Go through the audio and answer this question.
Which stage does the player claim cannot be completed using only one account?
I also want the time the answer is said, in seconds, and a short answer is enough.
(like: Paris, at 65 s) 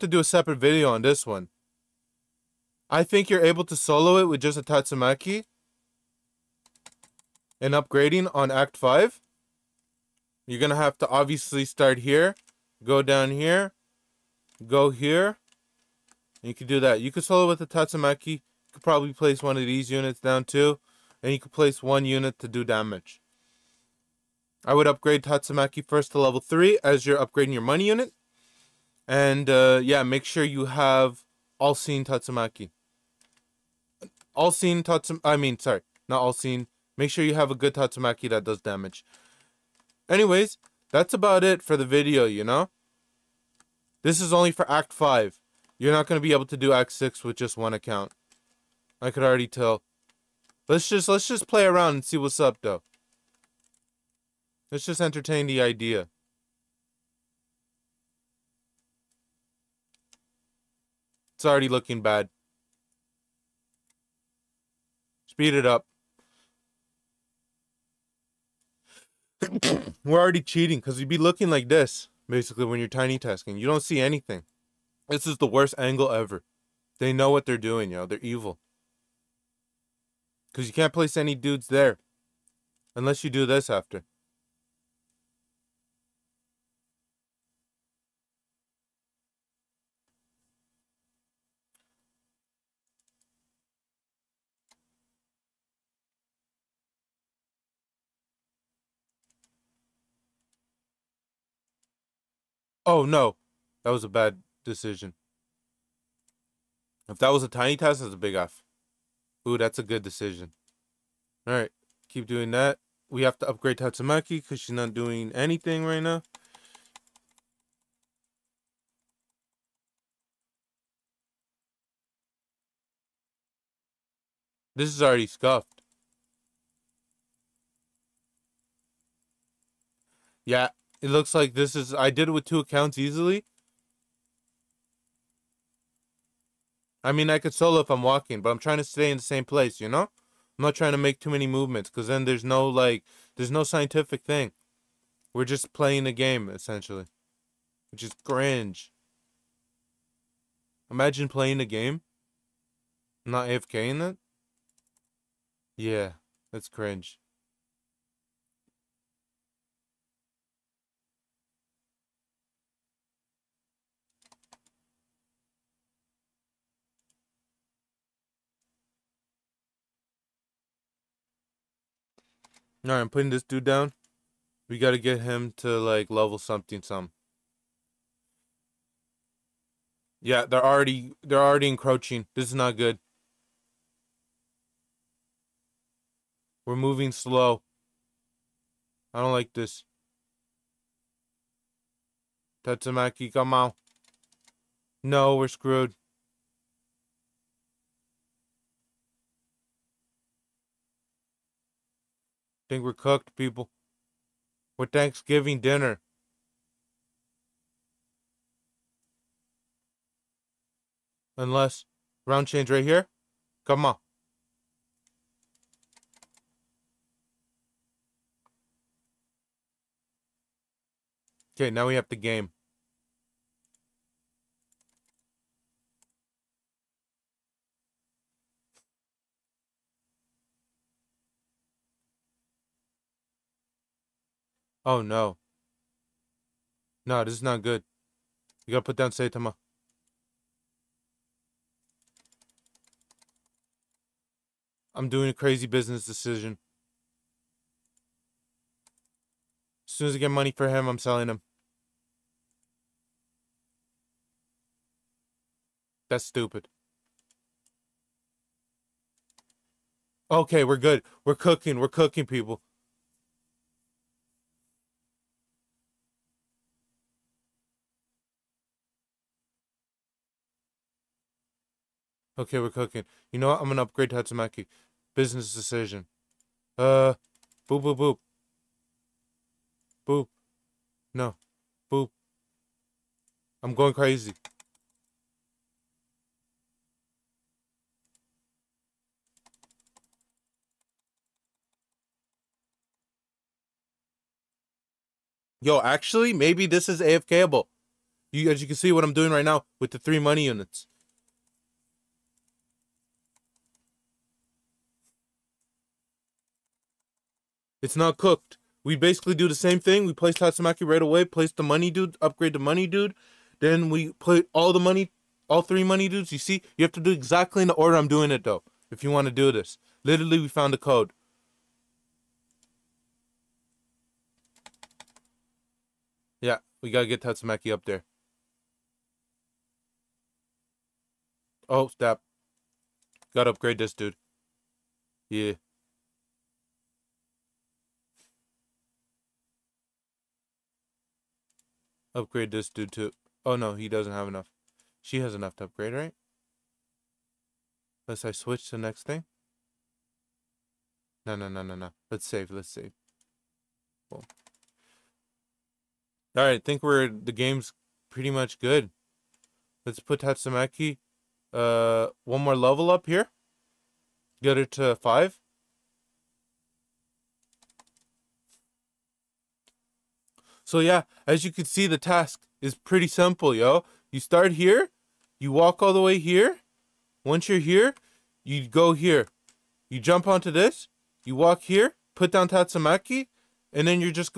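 Act 6, at 46 s.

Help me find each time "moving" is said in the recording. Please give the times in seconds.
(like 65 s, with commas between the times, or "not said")
186 s.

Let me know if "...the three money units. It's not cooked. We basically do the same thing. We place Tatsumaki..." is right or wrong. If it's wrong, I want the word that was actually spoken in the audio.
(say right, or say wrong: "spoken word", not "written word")
right.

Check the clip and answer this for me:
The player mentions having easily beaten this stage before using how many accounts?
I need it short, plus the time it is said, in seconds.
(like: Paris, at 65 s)
2, at 132 s.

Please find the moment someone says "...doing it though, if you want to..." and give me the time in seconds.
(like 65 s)
318 s.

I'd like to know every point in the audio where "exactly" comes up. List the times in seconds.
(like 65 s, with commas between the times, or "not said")
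317 s.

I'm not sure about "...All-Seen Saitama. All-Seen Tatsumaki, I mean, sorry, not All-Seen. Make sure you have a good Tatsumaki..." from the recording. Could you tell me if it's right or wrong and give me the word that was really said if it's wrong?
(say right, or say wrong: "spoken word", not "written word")
wrong: "Tatsumaki", not "Saitama".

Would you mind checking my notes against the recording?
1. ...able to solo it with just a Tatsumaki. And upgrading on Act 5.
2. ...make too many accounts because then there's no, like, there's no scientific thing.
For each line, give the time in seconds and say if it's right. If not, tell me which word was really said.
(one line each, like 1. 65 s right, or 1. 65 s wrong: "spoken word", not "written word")
1. 3 s right
2. 140 s wrong: "movements", not "accounts".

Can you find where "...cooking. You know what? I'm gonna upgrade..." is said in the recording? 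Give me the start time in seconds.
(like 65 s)
272 s.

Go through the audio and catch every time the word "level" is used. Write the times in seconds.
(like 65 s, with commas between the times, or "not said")
26 s, 176 s, 362 s.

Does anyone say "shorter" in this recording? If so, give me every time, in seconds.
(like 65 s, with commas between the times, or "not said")
not said.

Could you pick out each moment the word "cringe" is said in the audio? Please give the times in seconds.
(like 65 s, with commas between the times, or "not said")
148 s, 156 s.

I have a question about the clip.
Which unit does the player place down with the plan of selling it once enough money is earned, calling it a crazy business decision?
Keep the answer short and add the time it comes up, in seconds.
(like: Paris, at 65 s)
Saitama, at 239 s.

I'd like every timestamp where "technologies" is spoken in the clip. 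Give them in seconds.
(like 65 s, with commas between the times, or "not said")
not said.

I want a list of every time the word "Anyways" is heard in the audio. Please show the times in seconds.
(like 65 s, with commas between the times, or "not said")
40 s.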